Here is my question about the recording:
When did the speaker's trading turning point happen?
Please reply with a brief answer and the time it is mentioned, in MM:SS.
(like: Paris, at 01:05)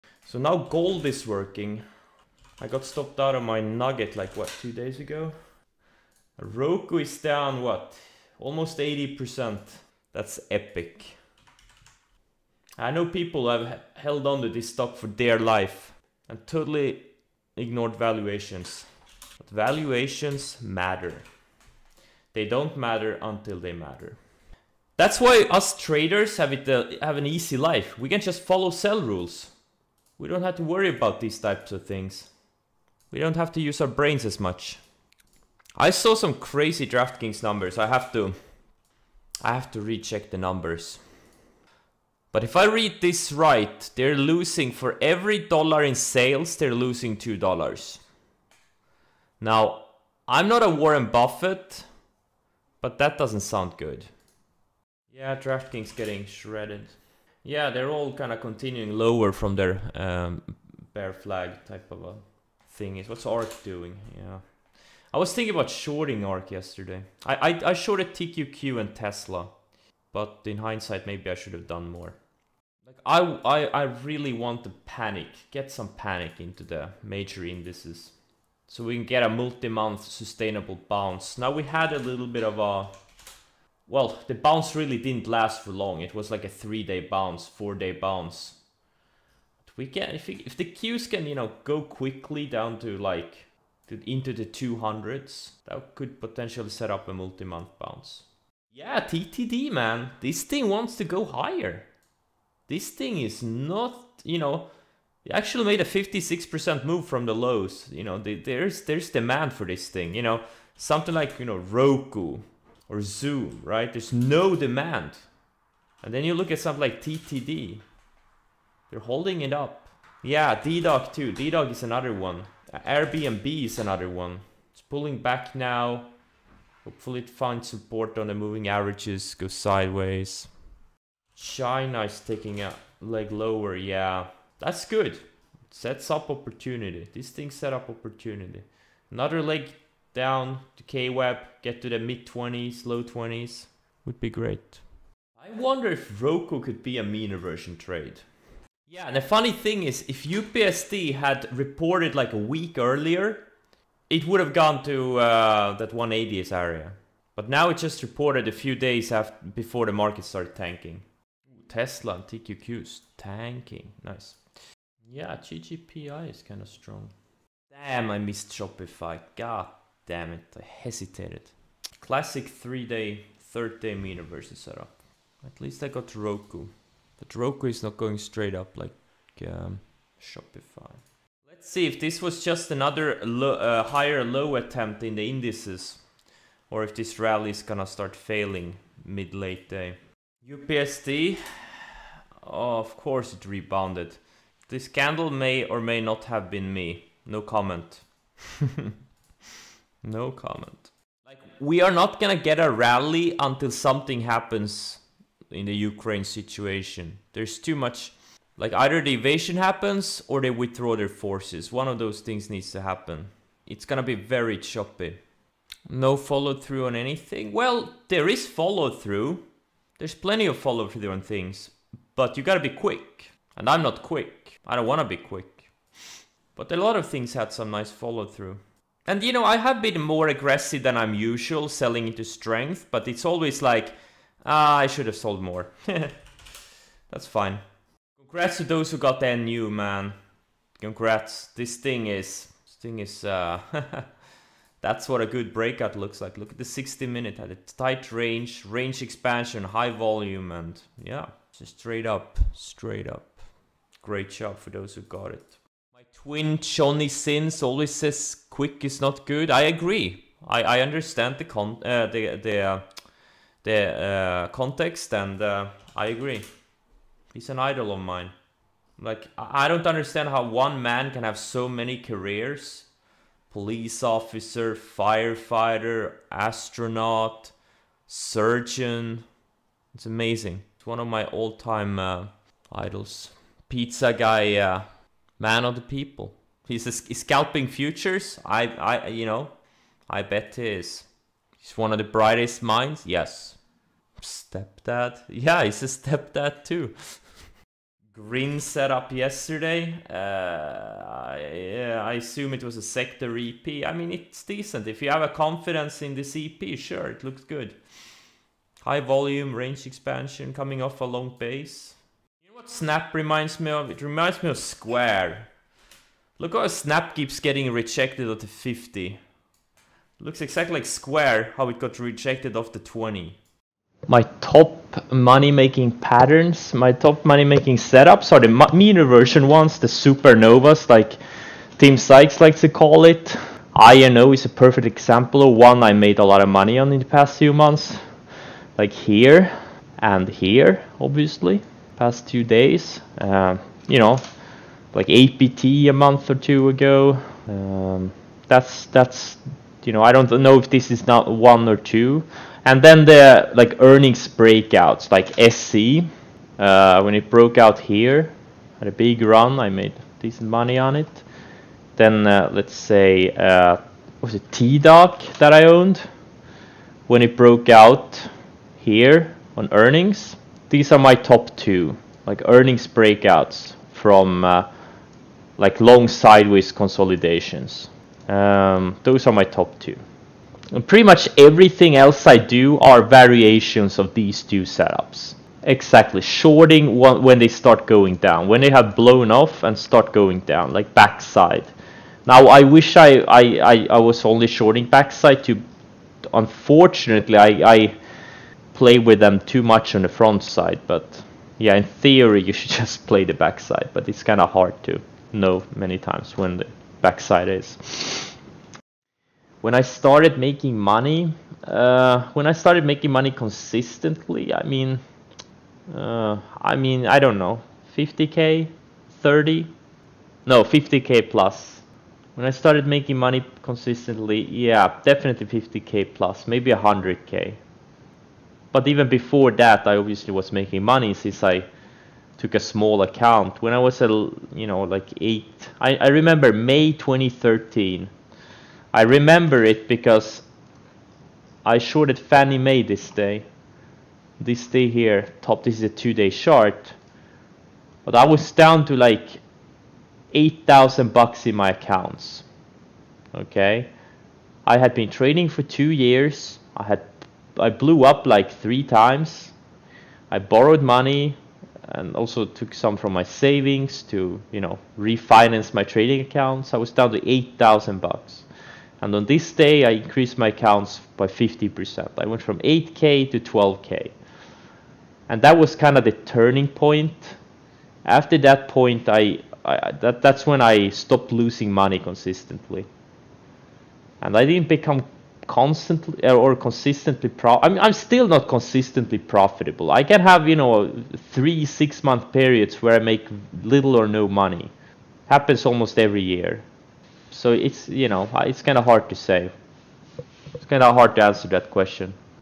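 May 2013, at 07:16.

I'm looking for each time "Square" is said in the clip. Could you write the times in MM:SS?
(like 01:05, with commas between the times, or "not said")
05:14, 05:20.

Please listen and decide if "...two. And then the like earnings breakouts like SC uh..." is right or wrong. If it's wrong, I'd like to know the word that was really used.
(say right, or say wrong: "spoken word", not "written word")
right.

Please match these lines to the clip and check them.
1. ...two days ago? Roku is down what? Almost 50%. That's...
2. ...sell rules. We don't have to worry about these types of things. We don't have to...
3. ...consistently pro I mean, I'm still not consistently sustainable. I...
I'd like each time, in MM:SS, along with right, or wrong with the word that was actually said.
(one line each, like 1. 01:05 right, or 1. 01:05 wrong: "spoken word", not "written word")
1. 00:04 wrong: "80", not "50"
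2. 00:28 right
3. 08:06 wrong: "profitable", not "sustainable".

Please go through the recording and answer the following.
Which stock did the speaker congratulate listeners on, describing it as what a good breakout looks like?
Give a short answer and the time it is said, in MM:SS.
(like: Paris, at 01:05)
NU, at 03:59.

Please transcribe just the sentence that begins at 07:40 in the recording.
I borrowed money and also took some from my savings to you know refinance my trading accounts.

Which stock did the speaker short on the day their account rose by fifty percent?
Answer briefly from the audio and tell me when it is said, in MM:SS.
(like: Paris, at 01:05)
Fannie Mae, at 07:22.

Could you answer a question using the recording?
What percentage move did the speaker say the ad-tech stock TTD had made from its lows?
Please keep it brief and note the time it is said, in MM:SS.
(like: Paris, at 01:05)
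56%, at 01:45.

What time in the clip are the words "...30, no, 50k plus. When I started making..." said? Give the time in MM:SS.
06:59.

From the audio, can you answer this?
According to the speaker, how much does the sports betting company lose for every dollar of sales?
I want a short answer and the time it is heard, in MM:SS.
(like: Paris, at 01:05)
2 dollars, at 00:47.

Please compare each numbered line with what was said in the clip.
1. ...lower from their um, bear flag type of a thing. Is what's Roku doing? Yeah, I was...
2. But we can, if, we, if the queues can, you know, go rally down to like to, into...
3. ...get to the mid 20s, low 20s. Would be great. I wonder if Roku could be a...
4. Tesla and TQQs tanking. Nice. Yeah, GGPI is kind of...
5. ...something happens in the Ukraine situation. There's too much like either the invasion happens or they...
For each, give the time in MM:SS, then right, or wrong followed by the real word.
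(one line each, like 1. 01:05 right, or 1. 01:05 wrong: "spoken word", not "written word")
1. 00:58 wrong: "ARK", not "Roku"
2. 01:29 wrong: "quickly", not "rally"
3. 02:21 right
4. 02:41 right
5. 03:23 right.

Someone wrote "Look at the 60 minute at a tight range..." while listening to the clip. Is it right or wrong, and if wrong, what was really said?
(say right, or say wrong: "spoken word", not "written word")
right.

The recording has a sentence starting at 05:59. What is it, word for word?
I made decent money on it.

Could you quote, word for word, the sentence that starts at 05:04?
If you have a confidence in this EP, sure, it looks good.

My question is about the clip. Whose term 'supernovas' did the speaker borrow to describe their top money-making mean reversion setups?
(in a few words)
Tim Sykes.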